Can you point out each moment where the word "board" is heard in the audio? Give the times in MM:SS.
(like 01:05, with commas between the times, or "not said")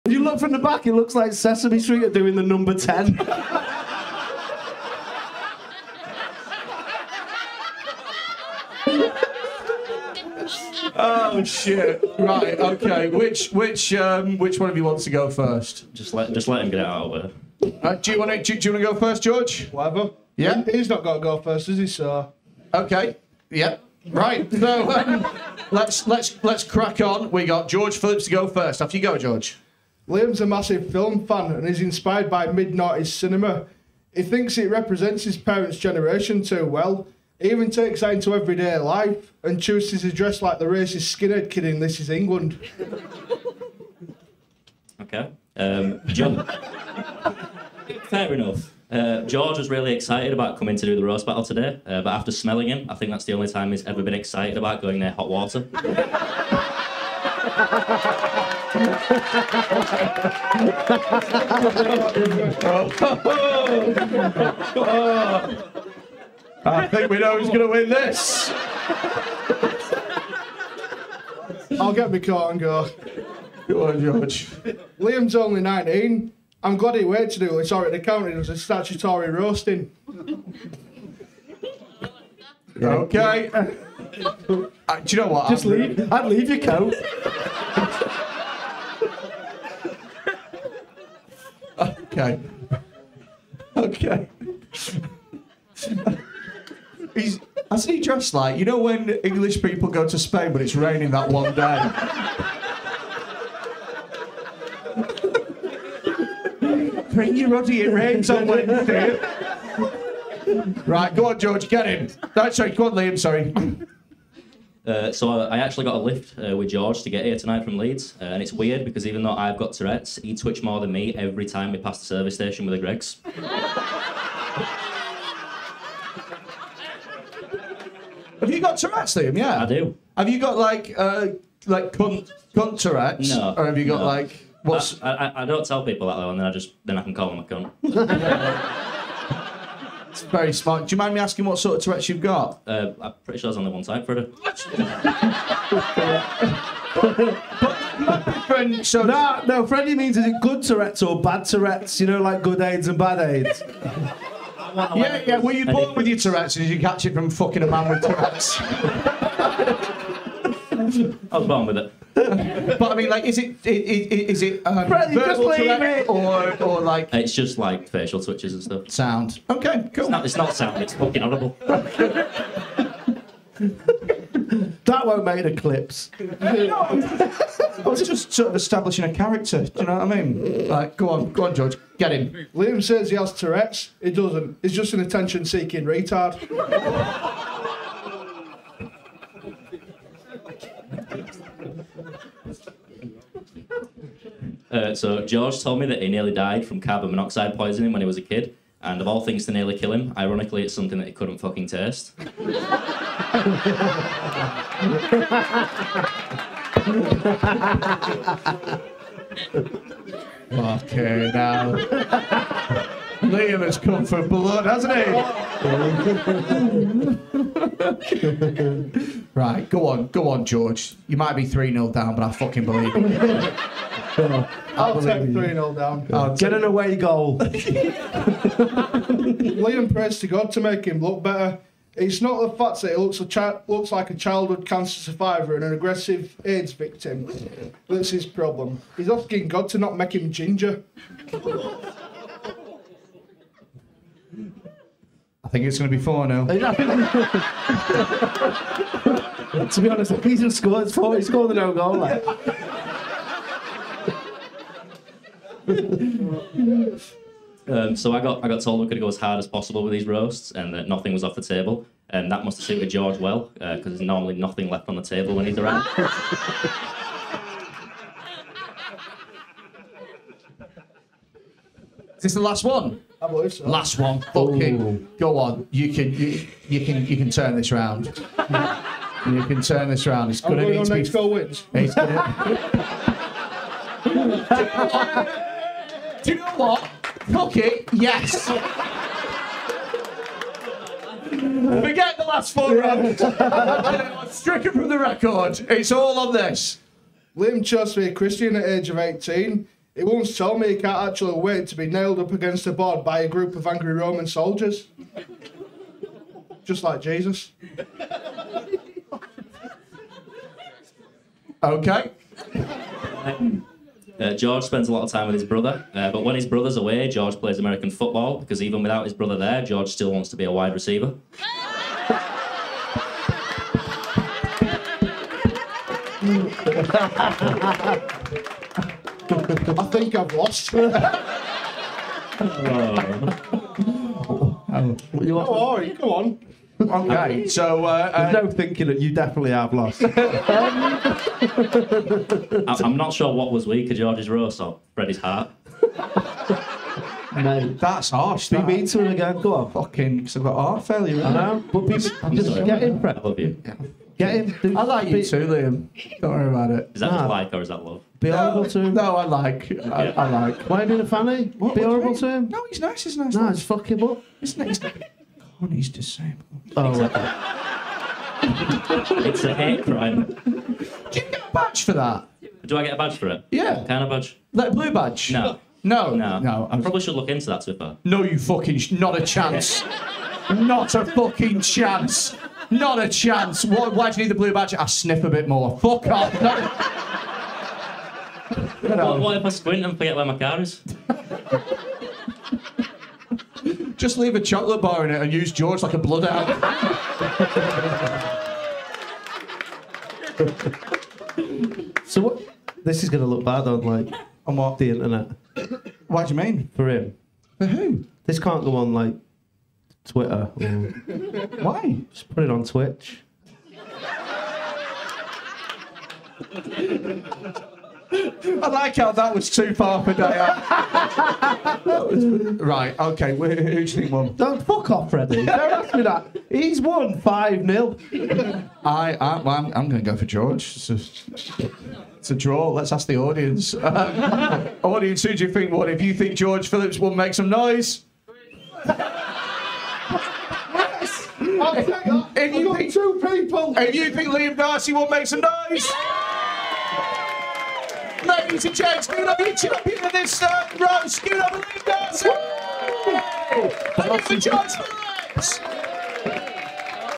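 05:02.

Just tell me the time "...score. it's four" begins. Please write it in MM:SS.
04:10.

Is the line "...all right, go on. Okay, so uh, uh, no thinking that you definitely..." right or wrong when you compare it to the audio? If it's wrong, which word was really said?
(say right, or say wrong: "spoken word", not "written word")
right.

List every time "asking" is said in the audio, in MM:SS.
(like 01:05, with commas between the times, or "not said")
02:21, 03:59.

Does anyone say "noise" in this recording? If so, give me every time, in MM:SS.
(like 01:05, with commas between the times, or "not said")
07:17, 07:25.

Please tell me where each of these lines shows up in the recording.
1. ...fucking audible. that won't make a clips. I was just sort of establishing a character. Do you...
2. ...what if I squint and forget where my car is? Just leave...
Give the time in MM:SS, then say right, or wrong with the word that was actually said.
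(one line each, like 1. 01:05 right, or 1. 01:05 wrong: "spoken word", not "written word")
1. 02:50 right
2. 06:29 right.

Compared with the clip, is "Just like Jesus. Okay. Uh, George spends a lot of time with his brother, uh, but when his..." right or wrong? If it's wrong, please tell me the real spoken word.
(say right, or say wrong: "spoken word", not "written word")
right.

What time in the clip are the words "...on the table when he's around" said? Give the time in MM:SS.
04:24.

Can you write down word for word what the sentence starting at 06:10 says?
Do you get a badge for that?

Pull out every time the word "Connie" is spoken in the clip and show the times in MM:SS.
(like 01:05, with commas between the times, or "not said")
06:05.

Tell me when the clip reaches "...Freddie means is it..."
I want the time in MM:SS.
02:29.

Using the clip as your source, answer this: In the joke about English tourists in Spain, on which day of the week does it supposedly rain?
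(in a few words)
Wednesday.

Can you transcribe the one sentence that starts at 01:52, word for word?
not sorry, go on, Liam, sorry.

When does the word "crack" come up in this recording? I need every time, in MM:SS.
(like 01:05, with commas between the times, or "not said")
00:26.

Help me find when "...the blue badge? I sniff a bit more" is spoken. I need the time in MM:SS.
06:24.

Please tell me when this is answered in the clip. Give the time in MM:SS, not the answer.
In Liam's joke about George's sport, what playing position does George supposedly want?
05:20.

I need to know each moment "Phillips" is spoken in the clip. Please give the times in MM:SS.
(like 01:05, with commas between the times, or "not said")
00:27, 07:16, 07:34.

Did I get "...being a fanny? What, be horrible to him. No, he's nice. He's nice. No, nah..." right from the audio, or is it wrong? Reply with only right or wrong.
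right.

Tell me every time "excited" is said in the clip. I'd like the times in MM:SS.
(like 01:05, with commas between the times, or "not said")
00:49, 00:54.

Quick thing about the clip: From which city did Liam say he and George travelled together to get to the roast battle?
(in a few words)
Leeds.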